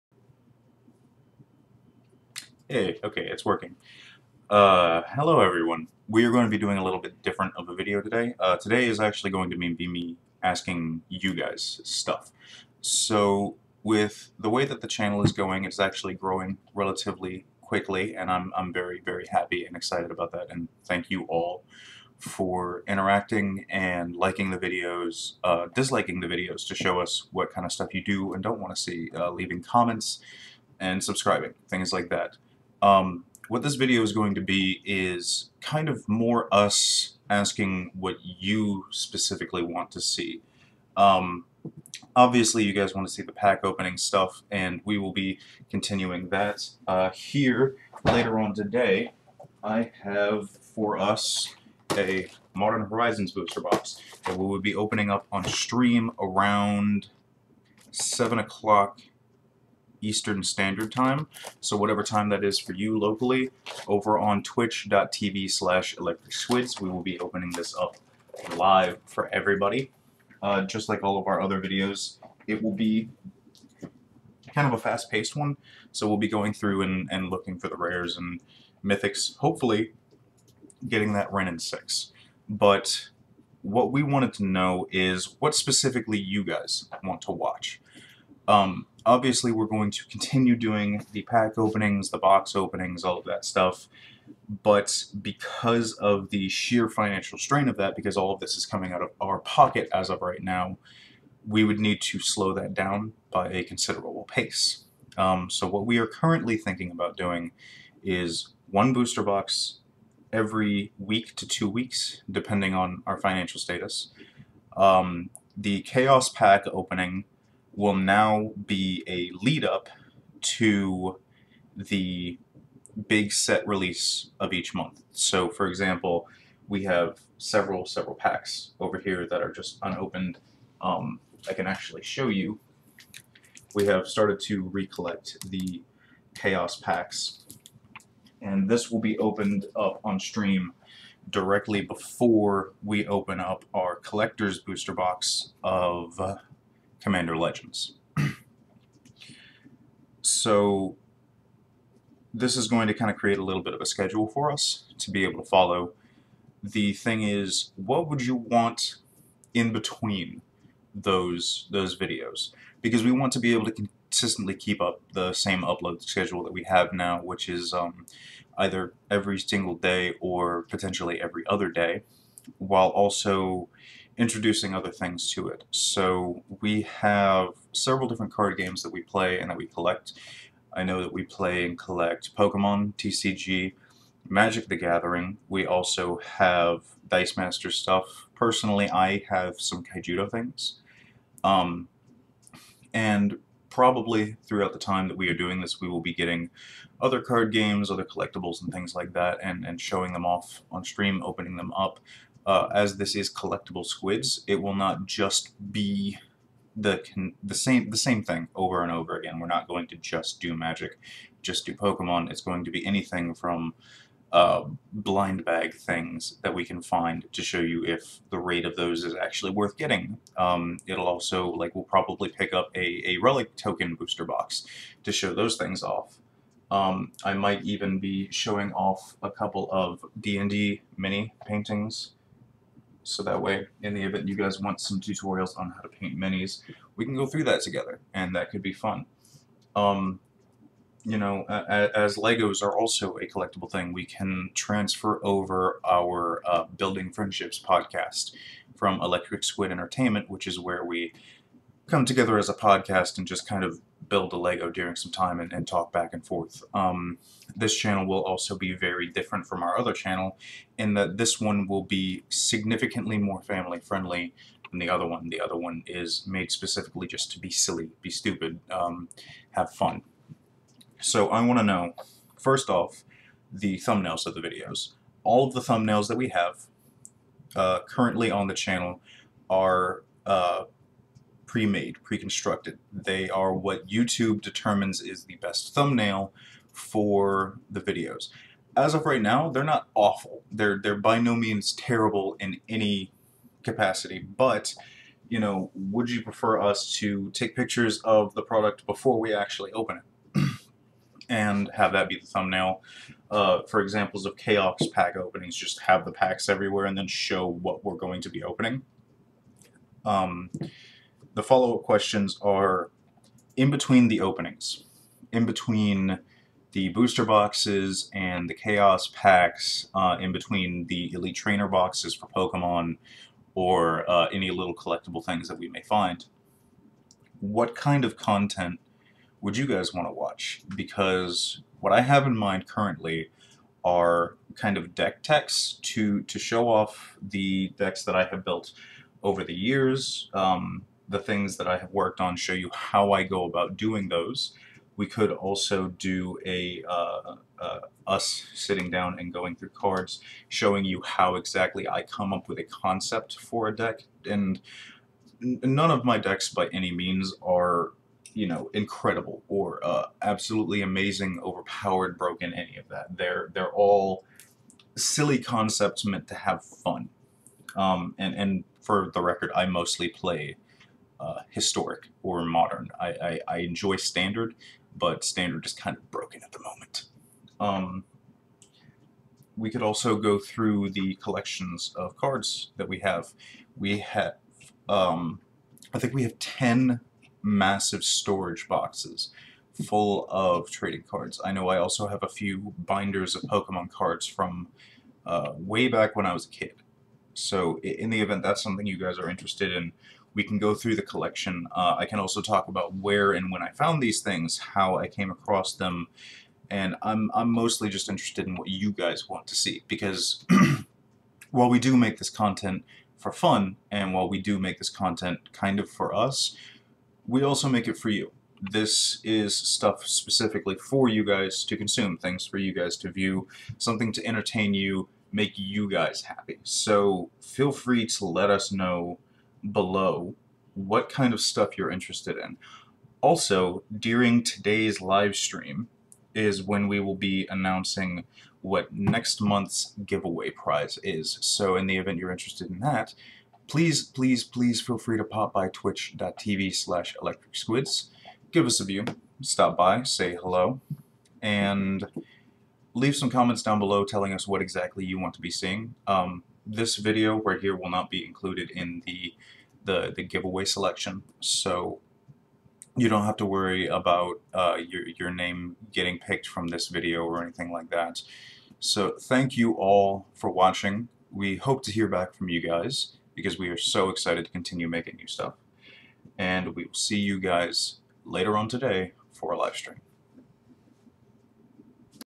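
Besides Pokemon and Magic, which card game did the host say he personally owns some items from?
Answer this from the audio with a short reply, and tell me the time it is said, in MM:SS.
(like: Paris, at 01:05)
Kaijudo, at 03:09.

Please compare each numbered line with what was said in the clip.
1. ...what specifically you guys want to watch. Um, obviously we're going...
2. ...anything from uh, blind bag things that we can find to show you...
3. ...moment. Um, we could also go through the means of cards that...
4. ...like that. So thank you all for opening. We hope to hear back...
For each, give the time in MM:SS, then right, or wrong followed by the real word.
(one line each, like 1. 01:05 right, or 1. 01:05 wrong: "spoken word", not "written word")
1. 01:25 right
2. 03:32 right
3. 06:16 wrong: "collections", not "means"
4. 07:47 wrong: "watching", not "opening".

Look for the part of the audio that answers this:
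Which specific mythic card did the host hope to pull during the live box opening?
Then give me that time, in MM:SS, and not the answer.
01:21.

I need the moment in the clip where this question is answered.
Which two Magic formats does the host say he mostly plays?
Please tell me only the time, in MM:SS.
06:11.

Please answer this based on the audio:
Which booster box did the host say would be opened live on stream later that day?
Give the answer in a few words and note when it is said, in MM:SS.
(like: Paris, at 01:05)
Modern Horizons, at 00:52.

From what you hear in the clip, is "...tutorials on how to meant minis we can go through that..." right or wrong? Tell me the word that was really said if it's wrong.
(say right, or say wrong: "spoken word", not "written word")
wrong: "paint", not "meant".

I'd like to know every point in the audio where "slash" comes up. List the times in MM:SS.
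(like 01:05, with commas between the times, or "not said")
01:05, 07:26.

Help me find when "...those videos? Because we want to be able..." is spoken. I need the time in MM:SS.
02:41.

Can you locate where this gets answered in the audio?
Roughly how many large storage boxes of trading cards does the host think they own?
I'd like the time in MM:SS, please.
06:26.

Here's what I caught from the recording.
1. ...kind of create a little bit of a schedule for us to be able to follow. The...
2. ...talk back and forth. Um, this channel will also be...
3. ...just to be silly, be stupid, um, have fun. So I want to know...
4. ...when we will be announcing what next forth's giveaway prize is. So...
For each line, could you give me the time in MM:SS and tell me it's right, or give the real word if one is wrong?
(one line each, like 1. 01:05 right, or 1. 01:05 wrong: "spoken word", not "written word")
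1. 02:32 right
2. 04:15 right
3. 04:27 right
4. 07:16 wrong: "month", not "forth".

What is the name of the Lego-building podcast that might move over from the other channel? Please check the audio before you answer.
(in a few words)
Building Friendships.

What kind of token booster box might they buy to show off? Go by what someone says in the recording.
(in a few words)
Relic token.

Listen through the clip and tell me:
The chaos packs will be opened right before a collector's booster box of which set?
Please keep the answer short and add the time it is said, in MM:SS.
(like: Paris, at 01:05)
Commander Legends, at 02:27.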